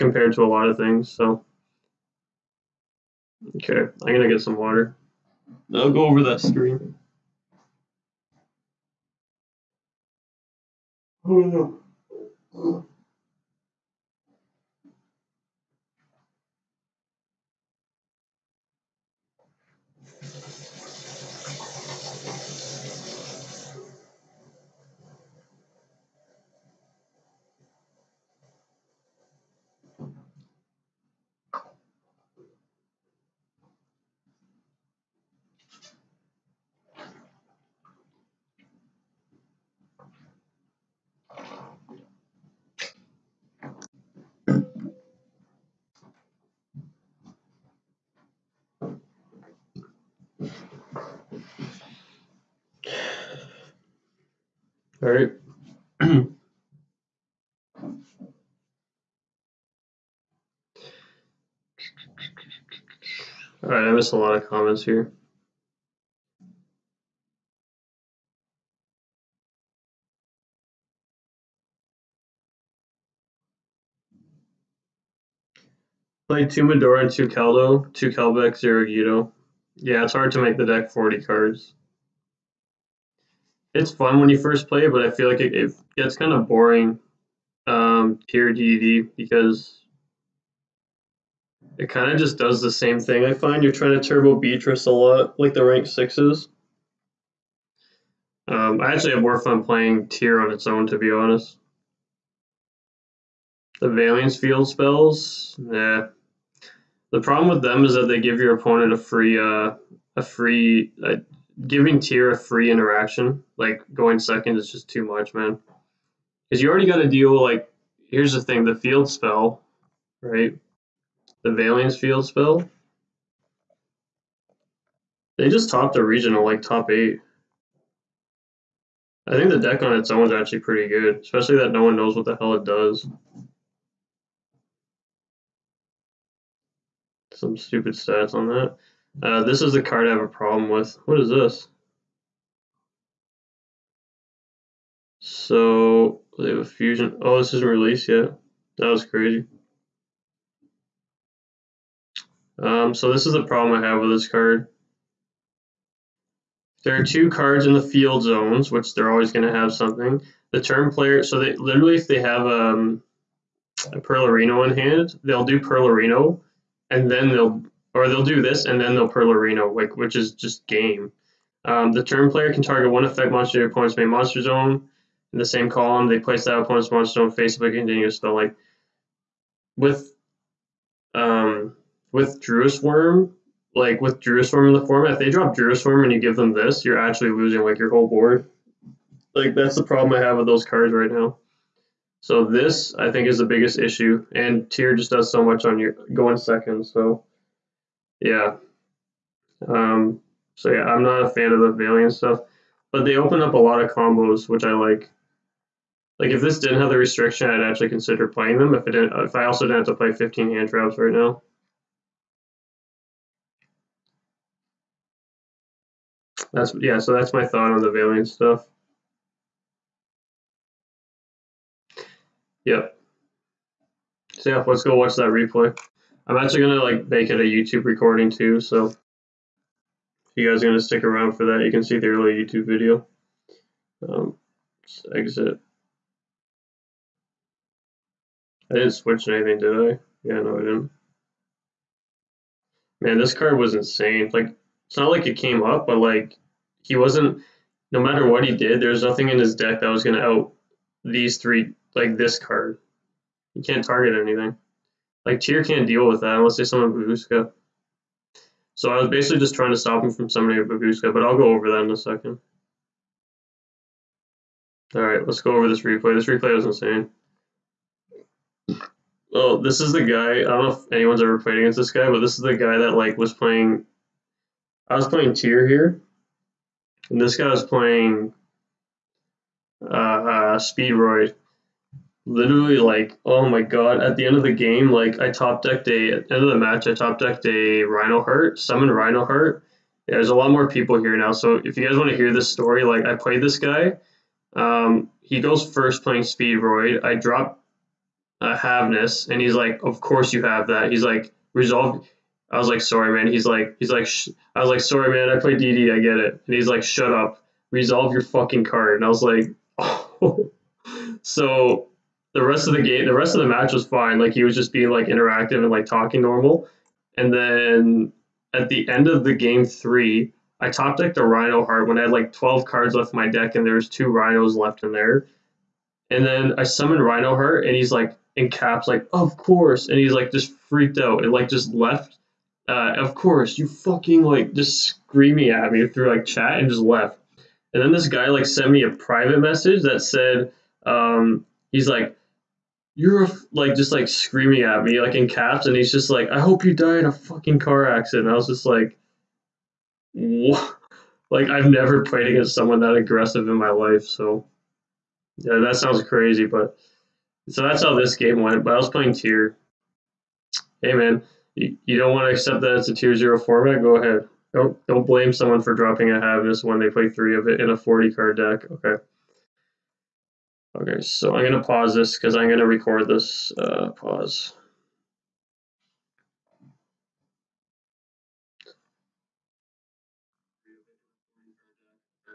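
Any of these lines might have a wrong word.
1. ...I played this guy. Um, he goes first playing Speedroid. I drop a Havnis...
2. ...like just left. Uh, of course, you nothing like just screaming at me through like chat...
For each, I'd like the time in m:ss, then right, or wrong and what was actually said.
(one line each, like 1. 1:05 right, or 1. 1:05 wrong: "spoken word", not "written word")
1. 4:53 right
2. 5:31 wrong: "fucking", not "nothing".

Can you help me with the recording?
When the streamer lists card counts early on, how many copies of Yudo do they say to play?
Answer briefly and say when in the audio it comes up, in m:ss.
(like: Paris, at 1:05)
0, at 1:18.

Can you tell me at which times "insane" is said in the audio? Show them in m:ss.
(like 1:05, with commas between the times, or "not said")
4:03, 4:26.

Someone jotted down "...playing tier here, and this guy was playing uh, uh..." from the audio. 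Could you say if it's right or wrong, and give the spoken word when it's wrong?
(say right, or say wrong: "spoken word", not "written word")
right.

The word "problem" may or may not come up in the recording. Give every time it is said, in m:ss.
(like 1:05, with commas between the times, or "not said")
1:47, 2:20, 2:33, 3:09.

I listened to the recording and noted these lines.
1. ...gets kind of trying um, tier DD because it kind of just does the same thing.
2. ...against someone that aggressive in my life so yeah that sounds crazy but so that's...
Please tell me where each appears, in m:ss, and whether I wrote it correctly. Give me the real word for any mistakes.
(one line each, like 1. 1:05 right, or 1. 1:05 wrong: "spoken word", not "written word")
1. 1:25 wrong: "boring", not "trying"
2. 5:52 right.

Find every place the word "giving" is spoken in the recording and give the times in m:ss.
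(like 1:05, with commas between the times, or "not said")
1:51.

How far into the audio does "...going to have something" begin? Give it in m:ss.
2:39.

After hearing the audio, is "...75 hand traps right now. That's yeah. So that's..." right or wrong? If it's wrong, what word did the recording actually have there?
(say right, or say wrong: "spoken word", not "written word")
wrong: "15", not "75".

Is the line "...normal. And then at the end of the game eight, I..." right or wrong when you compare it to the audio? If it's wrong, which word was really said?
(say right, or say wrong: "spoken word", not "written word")
wrong: "three", not "eight".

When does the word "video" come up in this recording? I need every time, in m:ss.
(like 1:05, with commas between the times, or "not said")
3:52.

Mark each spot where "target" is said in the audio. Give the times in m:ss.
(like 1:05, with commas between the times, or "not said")
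2:52, 4:13.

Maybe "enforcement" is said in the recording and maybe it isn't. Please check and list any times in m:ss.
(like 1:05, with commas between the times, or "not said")
not said.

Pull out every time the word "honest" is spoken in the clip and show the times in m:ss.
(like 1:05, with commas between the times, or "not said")
1:41.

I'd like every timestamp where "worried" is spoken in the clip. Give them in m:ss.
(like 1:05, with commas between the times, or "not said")
not said.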